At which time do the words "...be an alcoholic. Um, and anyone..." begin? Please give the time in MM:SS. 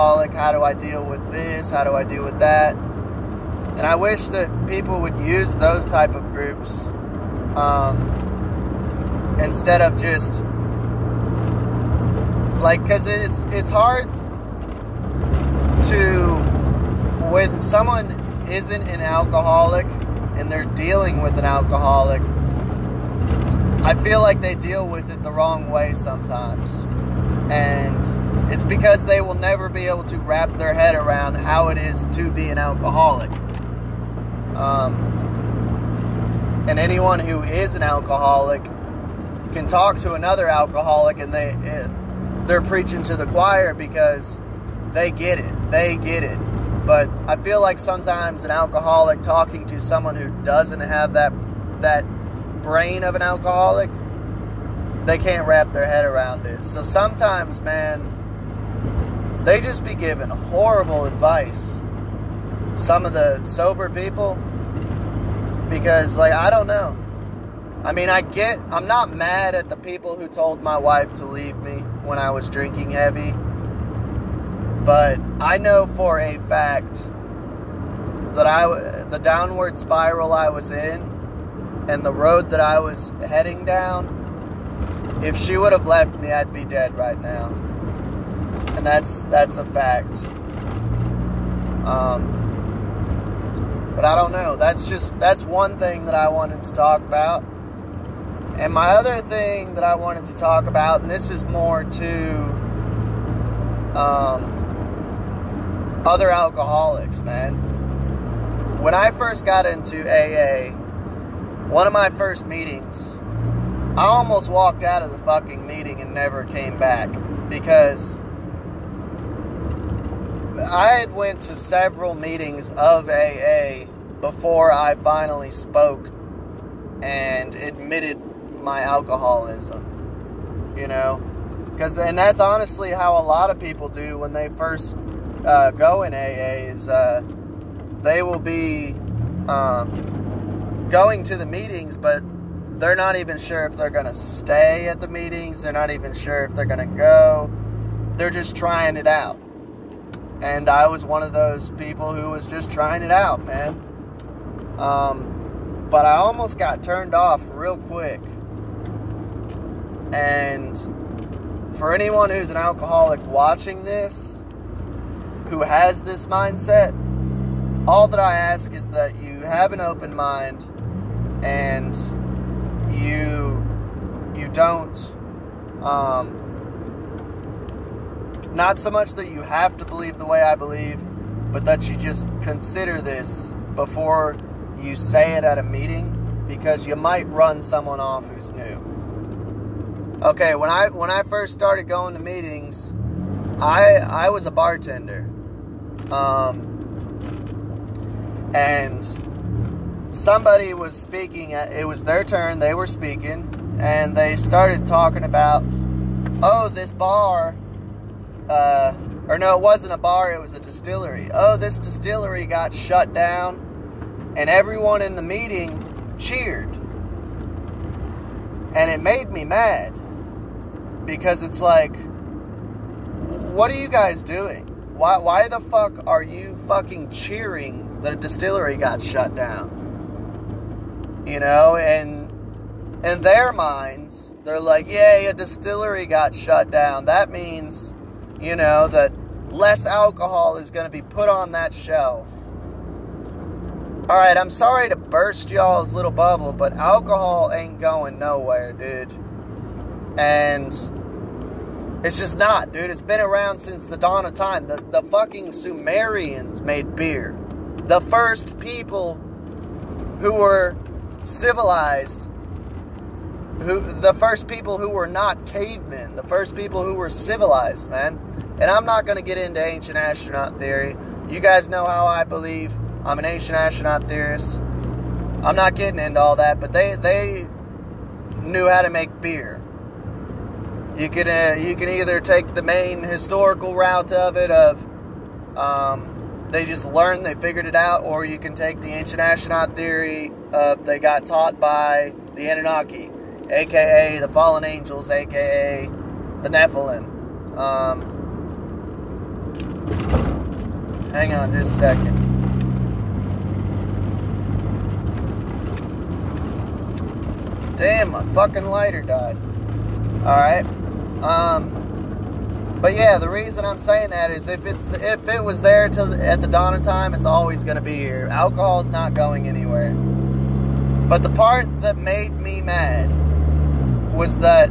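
00:32.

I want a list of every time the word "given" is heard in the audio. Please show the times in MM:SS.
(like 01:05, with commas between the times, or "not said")
00:59.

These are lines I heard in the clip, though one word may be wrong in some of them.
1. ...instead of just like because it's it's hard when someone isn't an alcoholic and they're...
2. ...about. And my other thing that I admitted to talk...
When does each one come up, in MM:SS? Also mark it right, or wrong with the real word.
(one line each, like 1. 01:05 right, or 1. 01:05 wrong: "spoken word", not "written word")
1. 00:09 right
2. 01:37 wrong: "wanted", not "admitted".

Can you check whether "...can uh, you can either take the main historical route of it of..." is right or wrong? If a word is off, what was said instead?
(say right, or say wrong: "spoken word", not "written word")
right.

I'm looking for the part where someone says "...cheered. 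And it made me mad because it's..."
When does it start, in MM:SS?
03:36.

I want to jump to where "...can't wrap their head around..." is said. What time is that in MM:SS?
00:55.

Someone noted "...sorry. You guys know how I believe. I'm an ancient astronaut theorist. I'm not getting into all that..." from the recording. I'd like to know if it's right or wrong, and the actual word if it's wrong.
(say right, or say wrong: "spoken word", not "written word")
wrong: "theory", not "sorry".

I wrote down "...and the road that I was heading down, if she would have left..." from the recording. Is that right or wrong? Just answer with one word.
right.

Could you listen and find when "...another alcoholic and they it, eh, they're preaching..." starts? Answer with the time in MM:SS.
00:40.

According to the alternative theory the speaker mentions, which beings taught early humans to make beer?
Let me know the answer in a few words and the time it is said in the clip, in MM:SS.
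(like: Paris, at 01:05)
The Anunnaki, at 04:52.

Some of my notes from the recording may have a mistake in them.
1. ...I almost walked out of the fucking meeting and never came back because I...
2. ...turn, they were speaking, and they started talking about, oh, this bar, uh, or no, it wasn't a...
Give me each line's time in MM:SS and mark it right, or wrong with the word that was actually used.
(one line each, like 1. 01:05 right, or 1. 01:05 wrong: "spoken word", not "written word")
1. 01:53 right
2. 03:22 right.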